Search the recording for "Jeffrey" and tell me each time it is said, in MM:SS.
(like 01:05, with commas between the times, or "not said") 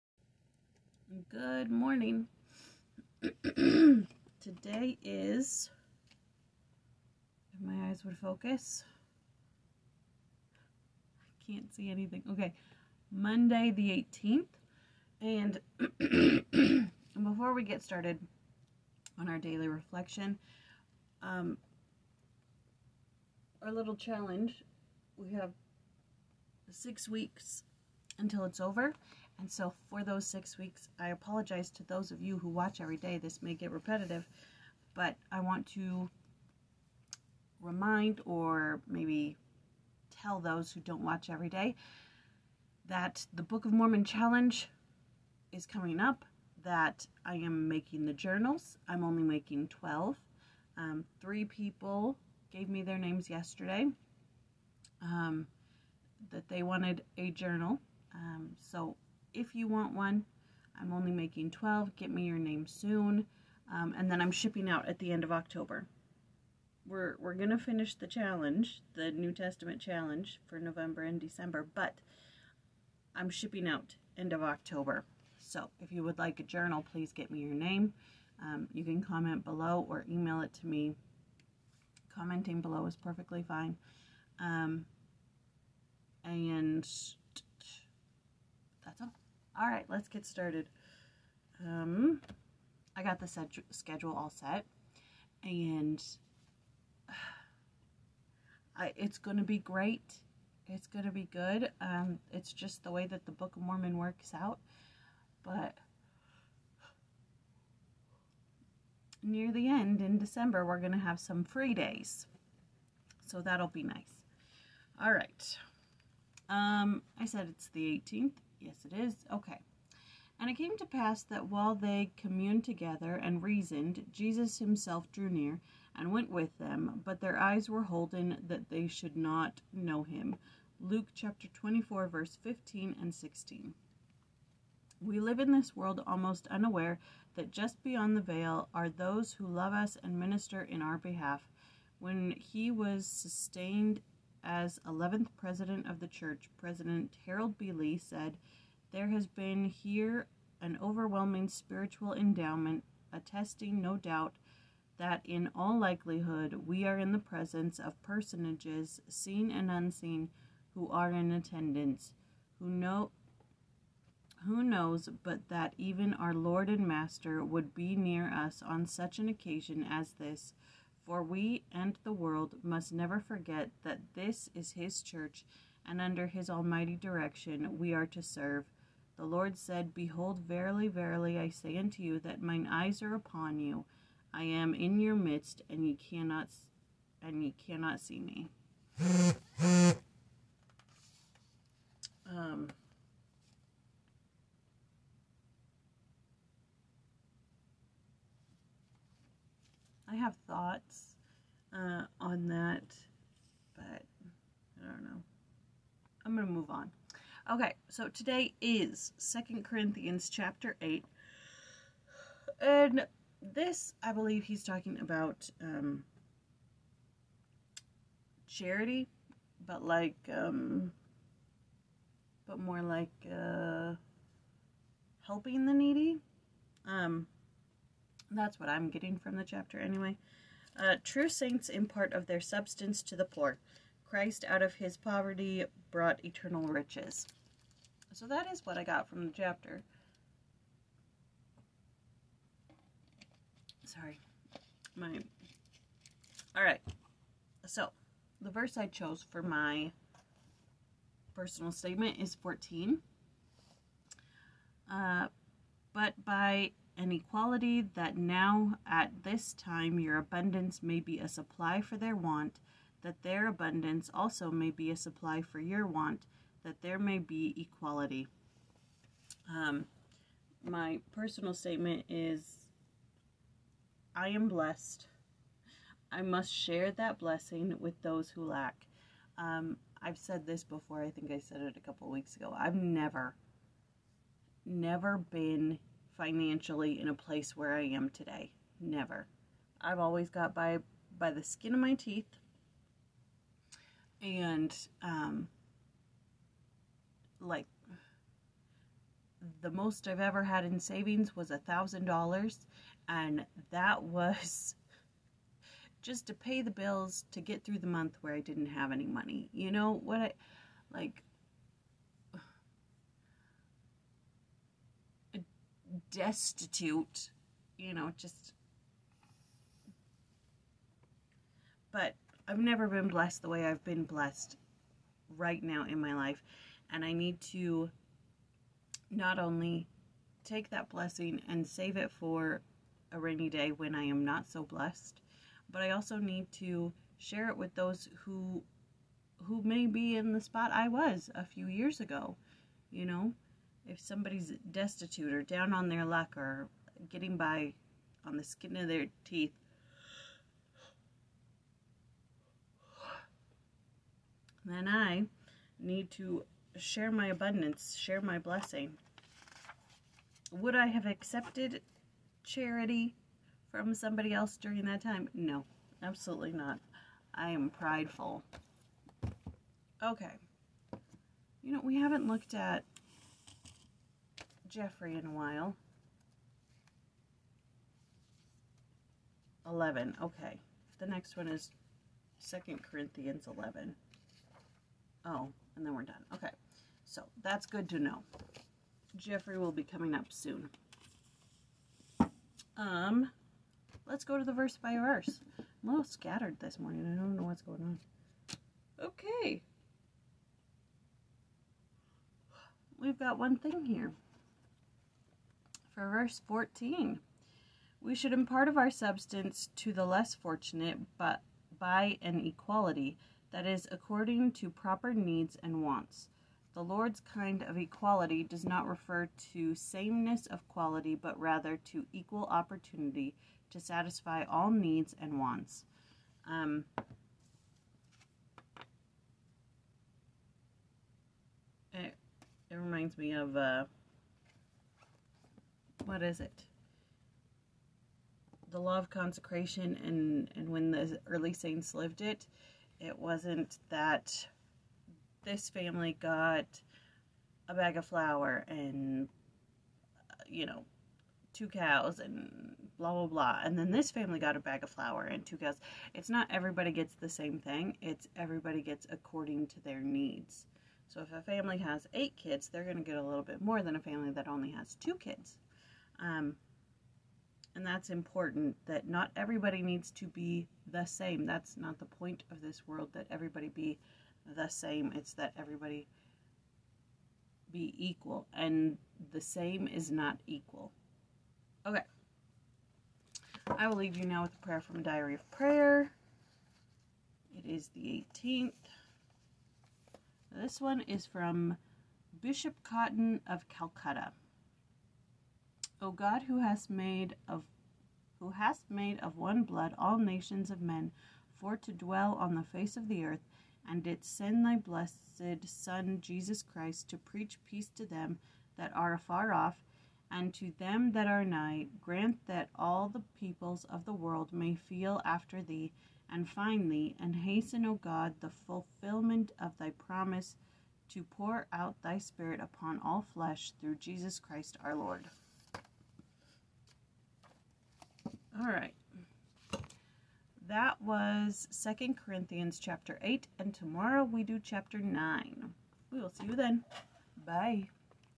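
06:14, 06:29.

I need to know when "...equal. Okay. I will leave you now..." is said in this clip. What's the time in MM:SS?
08:00.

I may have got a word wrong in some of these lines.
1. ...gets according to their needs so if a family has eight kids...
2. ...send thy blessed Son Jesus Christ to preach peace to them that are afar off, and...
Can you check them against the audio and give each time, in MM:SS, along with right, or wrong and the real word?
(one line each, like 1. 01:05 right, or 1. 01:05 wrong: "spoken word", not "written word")
1. 07:38 right
2. 08:24 right.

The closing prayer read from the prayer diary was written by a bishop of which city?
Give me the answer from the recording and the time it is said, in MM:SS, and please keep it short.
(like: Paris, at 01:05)
Calcutta, at 08:13.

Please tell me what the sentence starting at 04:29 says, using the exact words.
Um, my personal statement is I am blessed.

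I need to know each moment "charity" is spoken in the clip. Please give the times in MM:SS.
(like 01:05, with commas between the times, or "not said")
03:38, 06:02.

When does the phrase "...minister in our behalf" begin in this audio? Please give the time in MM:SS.
02:20.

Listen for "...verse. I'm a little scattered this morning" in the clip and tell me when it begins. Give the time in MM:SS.
06:34.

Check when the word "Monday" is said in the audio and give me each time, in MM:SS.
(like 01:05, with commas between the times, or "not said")
00:13.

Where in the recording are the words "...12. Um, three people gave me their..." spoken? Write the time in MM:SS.
00:49.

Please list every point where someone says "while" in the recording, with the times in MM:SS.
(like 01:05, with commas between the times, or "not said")
02:01, 06:15.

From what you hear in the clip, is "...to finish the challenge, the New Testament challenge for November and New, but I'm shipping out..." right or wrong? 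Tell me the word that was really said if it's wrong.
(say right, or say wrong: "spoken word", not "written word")
wrong: "December", not "New".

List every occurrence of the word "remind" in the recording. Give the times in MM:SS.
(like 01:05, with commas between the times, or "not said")
00:37, 07:12.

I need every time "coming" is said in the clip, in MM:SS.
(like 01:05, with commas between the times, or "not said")
00:45, 06:29.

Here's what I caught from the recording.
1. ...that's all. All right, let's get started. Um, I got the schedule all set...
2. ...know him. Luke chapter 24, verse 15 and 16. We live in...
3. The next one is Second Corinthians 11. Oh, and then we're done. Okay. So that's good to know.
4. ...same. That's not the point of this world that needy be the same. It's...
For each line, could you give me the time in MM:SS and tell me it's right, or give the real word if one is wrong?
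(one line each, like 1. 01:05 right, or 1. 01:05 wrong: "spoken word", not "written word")
1. 01:28 right
2. 02:09 right
3. 06:20 right
4. 07:51 wrong: "everybody", not "needy".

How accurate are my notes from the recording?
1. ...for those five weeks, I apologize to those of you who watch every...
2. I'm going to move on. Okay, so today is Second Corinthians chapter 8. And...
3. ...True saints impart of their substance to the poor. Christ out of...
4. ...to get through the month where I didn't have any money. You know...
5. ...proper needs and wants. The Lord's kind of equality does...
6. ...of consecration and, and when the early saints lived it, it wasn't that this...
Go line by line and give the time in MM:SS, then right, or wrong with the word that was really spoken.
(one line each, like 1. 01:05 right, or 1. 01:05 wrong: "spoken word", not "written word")
1. 00:29 wrong: "six", not "five"
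2. 03:26 right
3. 03:51 right
4. 05:07 right
5. 06:54 right
6. 07:18 right.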